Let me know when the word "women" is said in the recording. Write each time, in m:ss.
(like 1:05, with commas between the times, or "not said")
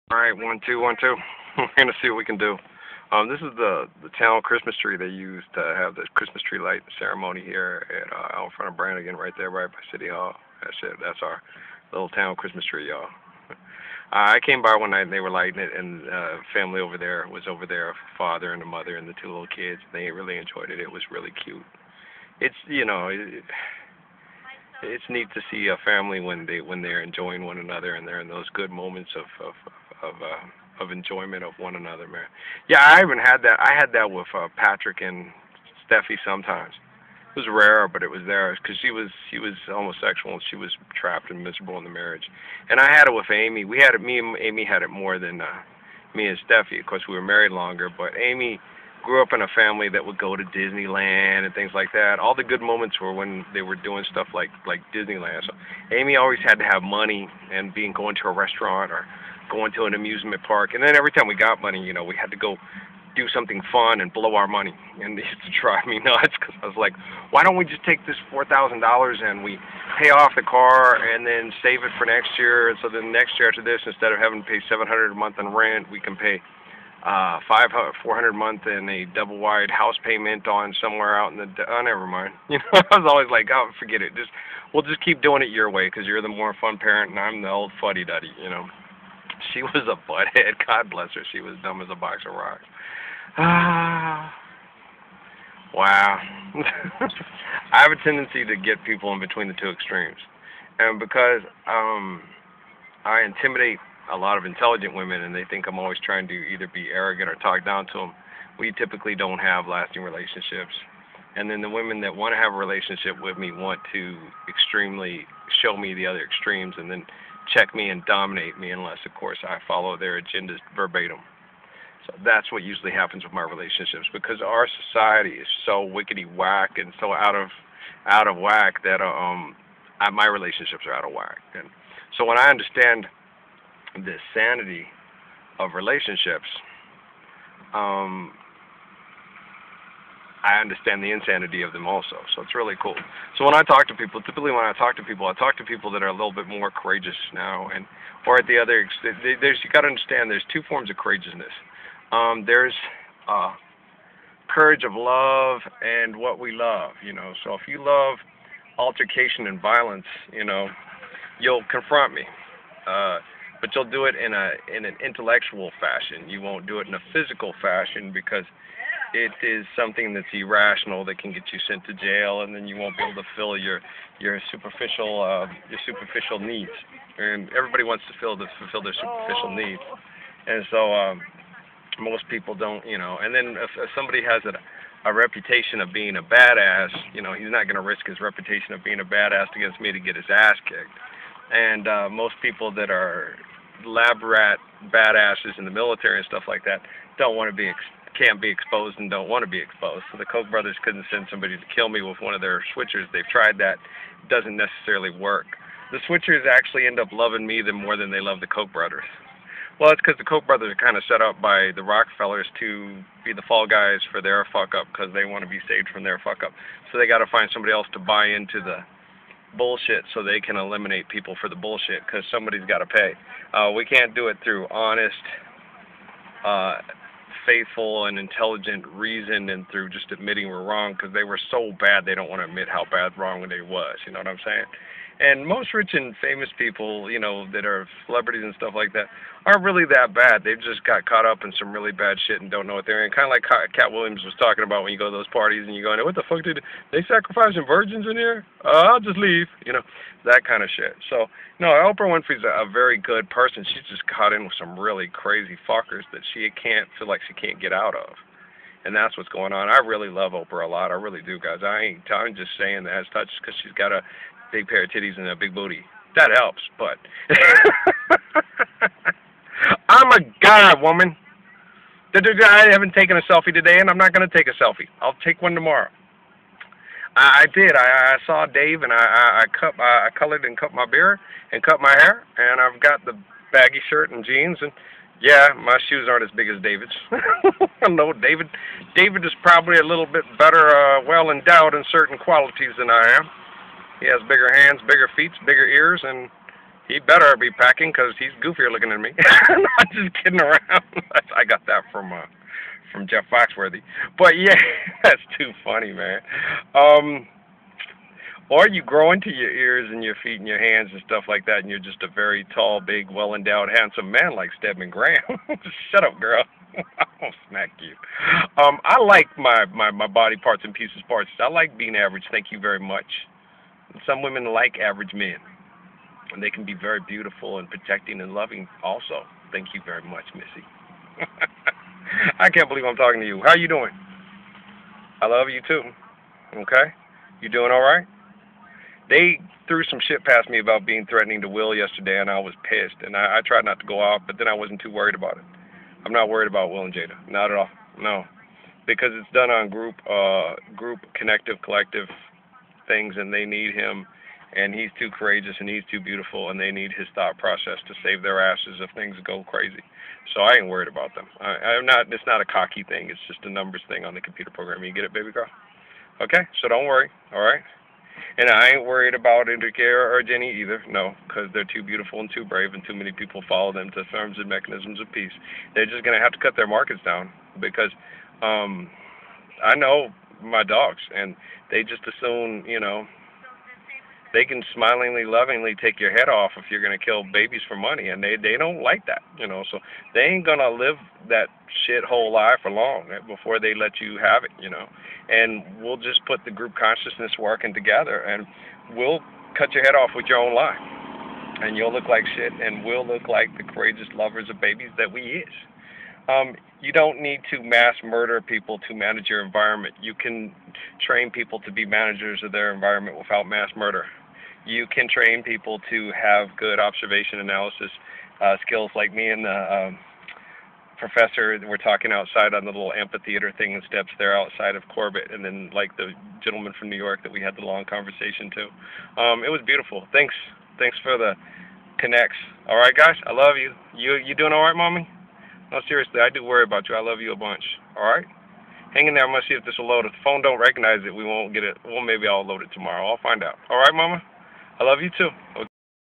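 1:44, 1:51, 5:24.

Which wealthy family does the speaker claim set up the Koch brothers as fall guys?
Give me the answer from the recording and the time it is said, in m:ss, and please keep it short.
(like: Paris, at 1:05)
the Rockefellers, at 3:31.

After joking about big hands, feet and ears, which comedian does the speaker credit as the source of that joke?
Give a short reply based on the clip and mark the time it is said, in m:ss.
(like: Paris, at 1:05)
Jeff Foxworthy, at 5:03.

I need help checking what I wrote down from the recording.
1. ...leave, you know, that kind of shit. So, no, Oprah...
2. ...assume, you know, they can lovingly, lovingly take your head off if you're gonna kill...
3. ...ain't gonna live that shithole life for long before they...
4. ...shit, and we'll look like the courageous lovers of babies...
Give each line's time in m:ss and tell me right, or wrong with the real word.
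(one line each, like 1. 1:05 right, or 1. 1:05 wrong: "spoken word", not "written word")
1. 4:09 right
2. 6:22 wrong: "smilingly", not "lovingly"
3. 6:30 right
4. 6:42 right.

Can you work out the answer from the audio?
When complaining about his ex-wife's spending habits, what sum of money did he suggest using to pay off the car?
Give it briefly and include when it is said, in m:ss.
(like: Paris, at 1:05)
$4,000, at 1:08.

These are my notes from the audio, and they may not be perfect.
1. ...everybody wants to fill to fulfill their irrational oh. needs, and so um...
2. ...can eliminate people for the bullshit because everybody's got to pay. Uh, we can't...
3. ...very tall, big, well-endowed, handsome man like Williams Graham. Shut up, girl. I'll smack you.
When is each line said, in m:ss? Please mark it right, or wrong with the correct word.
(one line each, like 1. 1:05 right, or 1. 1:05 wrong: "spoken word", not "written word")
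1. 2:57 wrong: "superficial", not "irrational"
2. 3:40 wrong: "somebody", not "everybody"
3. 5:12 wrong: "Stedman", not "Williams".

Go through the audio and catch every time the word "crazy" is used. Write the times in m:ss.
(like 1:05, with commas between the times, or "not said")
4:15, 5:59.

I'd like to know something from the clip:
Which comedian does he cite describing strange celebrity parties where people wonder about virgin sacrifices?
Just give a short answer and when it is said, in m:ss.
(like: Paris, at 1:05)
Katt Williams, at 4:03.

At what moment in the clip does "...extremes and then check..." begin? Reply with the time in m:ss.
1:56.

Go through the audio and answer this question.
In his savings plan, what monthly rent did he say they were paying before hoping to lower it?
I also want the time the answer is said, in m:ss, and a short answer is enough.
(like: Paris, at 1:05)
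700, at 1:14.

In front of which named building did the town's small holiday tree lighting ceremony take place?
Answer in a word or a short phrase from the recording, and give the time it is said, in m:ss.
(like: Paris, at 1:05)
Branigan, at 0:08.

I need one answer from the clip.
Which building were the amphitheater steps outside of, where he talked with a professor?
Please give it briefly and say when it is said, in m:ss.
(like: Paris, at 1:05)
Corbett, at 7:04.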